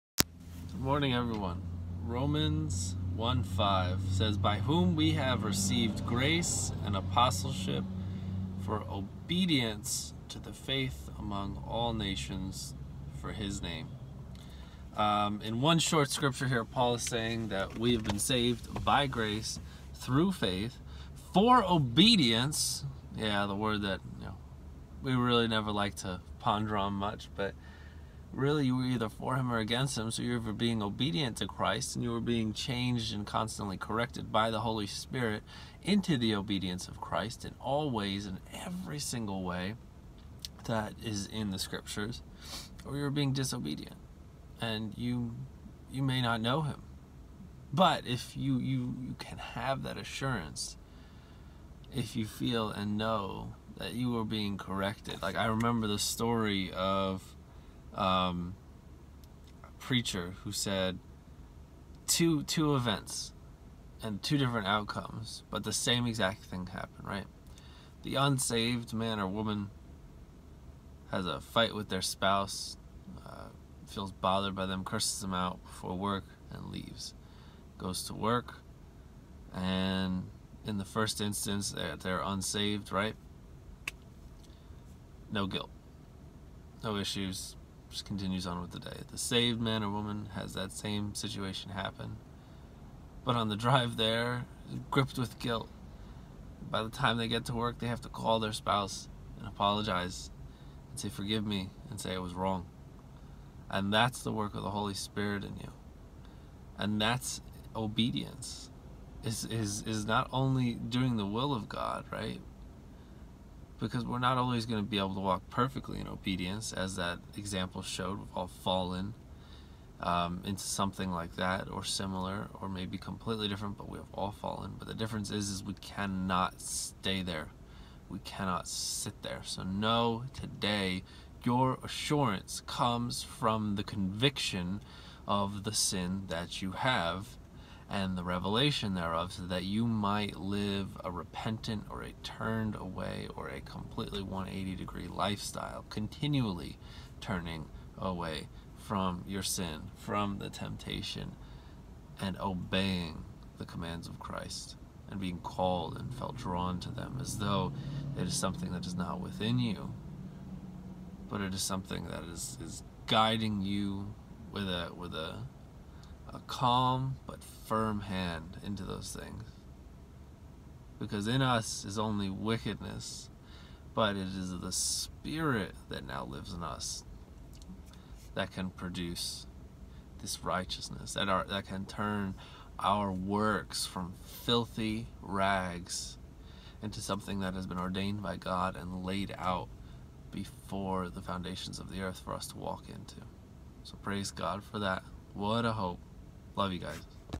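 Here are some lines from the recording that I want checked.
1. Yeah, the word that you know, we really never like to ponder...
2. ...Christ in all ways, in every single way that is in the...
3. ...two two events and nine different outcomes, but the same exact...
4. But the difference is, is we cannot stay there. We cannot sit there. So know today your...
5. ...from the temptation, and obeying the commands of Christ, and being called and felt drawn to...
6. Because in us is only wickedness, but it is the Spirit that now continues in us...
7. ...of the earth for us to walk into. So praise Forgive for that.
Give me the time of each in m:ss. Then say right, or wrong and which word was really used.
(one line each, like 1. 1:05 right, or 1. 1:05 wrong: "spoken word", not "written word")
1. 0:23 right
2. 0:37 right
3. 1:02 wrong: "two", not "nine"
4. 2:04 right
5. 2:29 right
6. 2:50 wrong: "lives", not "continues"
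7. 3:11 wrong: "God", not "Forgive".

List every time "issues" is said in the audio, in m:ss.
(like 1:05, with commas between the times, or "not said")
1:26.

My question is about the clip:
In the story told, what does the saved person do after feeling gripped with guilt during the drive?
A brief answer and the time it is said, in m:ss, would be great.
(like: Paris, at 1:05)
call their spouse, at 1:38.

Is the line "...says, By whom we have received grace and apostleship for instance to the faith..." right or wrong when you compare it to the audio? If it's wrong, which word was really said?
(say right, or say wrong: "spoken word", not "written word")
wrong: "obedience", not "instance".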